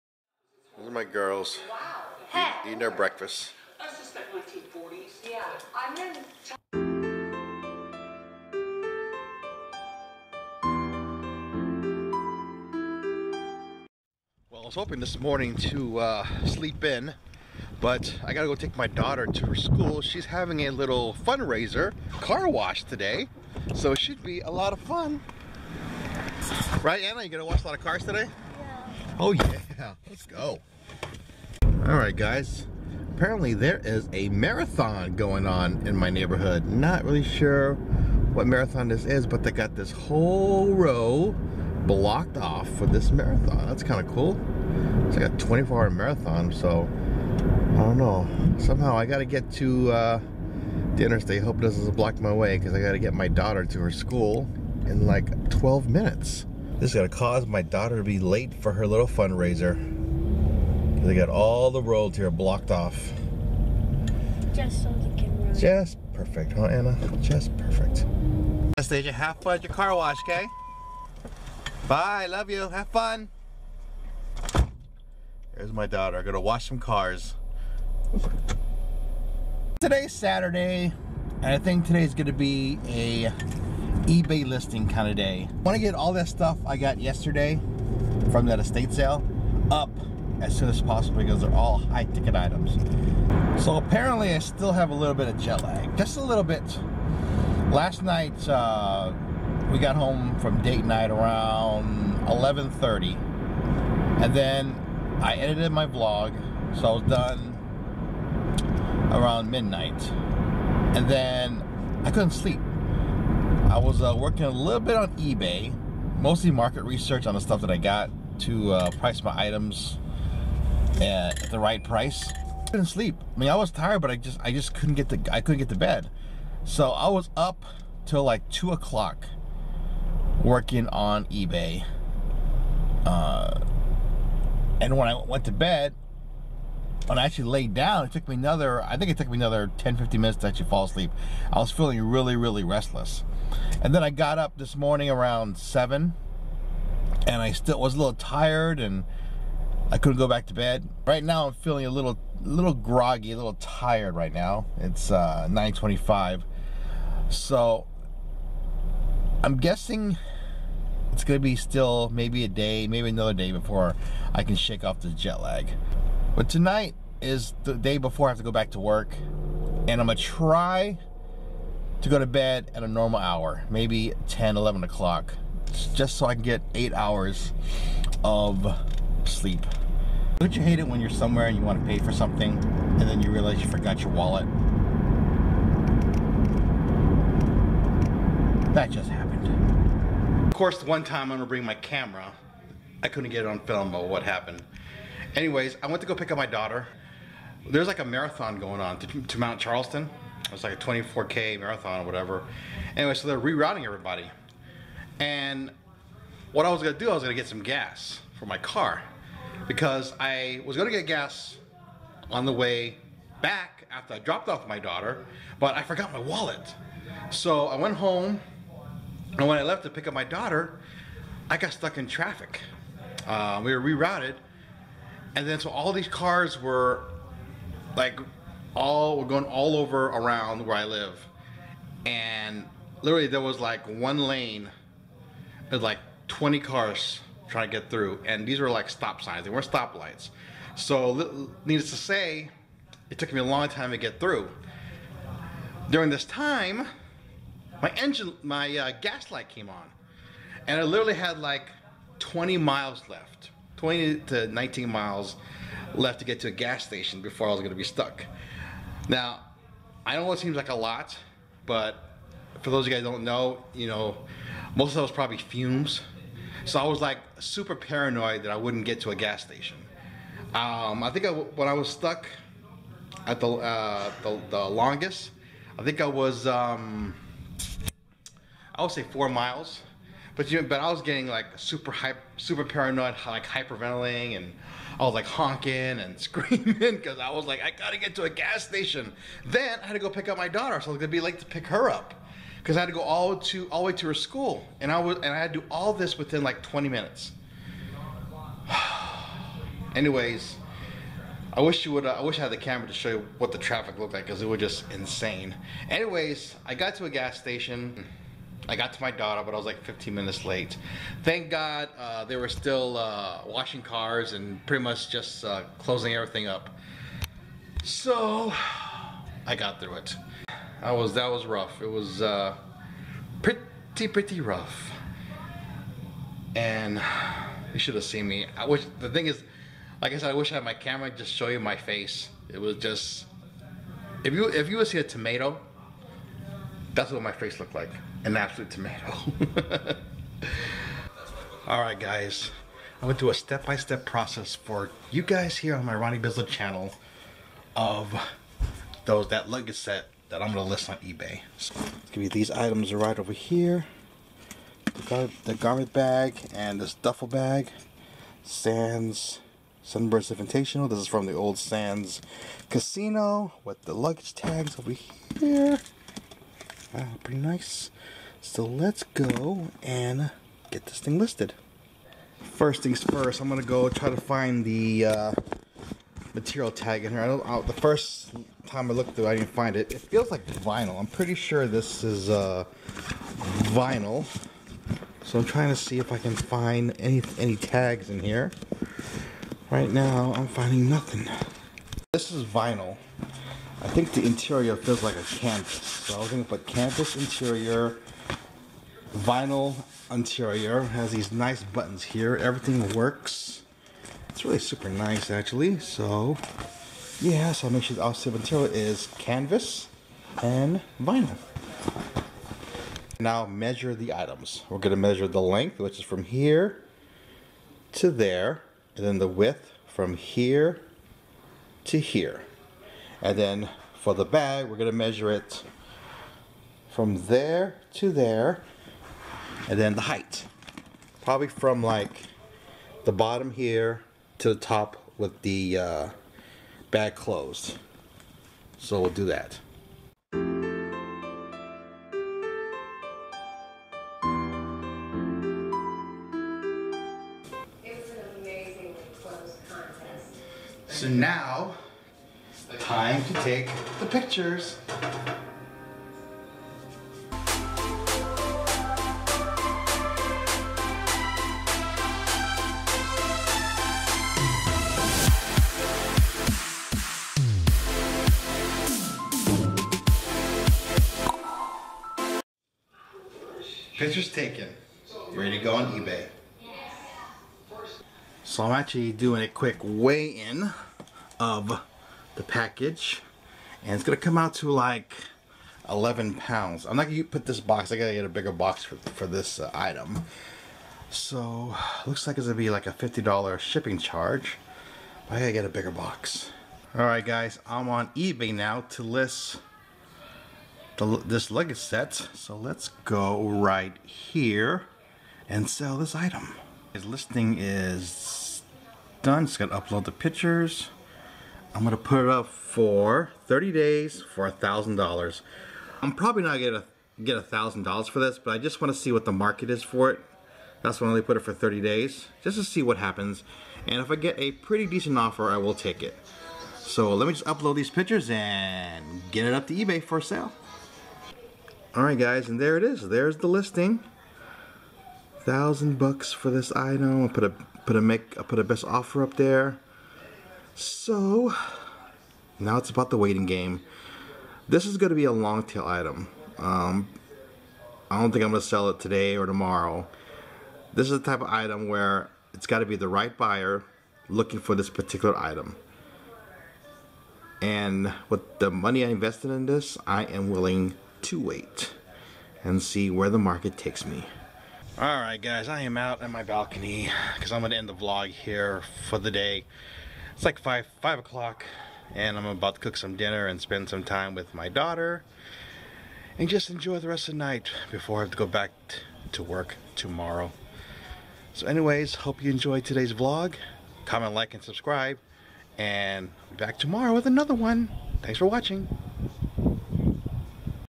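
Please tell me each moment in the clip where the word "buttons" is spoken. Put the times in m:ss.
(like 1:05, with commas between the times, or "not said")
6:41.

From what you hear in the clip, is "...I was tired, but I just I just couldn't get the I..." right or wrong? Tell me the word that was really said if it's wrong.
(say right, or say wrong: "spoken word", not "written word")
right.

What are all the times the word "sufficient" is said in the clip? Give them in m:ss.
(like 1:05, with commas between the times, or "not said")
not said.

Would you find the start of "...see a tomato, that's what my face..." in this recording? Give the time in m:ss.
5:34.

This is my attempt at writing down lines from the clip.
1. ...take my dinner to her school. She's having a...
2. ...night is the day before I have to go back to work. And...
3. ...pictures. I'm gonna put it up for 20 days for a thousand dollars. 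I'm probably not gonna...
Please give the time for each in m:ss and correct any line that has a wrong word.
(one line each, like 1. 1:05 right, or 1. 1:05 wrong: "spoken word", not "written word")
1. 0:18 wrong: "daughter", not "dinner"
2. 2:46 wrong: "tonight", not "night"
3. 8:30 wrong: "30", not "20".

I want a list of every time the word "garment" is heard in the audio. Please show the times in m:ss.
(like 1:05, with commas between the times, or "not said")
5:55.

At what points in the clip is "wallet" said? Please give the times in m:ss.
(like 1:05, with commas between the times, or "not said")
3:04, 3:36.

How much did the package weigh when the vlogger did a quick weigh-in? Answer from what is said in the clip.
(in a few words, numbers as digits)
11 pounds.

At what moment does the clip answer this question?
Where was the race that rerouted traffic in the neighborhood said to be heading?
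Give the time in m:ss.
3:19.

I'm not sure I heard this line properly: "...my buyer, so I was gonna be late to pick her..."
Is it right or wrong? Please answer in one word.
wrong.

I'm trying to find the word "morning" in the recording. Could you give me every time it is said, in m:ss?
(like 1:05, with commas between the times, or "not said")
0:15, 2:24.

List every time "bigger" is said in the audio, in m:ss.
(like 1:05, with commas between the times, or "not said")
8:08, 8:15.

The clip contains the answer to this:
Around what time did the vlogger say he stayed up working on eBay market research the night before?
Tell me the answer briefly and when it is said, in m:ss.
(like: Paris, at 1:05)
2 o'clock, at 2:08.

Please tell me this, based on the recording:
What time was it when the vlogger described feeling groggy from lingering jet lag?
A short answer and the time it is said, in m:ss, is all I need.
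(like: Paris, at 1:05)
9:25, at 2:35.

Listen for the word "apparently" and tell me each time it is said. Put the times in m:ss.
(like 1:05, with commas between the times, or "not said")
0:33, 1:33.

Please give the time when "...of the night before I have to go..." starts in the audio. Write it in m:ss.
9:37.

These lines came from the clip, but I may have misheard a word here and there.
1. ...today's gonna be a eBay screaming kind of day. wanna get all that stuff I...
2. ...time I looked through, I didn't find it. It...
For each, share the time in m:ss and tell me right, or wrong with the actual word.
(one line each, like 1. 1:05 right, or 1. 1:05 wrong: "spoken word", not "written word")
1. 1:21 wrong: "listing", not "screaming"
2. 6:18 right.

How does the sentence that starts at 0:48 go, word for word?
Somehow I got to get to uh, the interstate.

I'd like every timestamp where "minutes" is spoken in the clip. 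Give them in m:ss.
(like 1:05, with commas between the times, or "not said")
0:55, 2:20, 4:56, 5:10.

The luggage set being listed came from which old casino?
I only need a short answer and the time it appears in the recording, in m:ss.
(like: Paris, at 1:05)
Sands Casino, at 6:01.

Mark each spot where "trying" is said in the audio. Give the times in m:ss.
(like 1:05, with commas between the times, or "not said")
3:57, 6:25.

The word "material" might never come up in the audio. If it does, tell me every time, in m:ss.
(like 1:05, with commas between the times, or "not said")
6:16, 6:48.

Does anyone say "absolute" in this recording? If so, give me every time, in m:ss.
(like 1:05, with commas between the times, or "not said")
5:38.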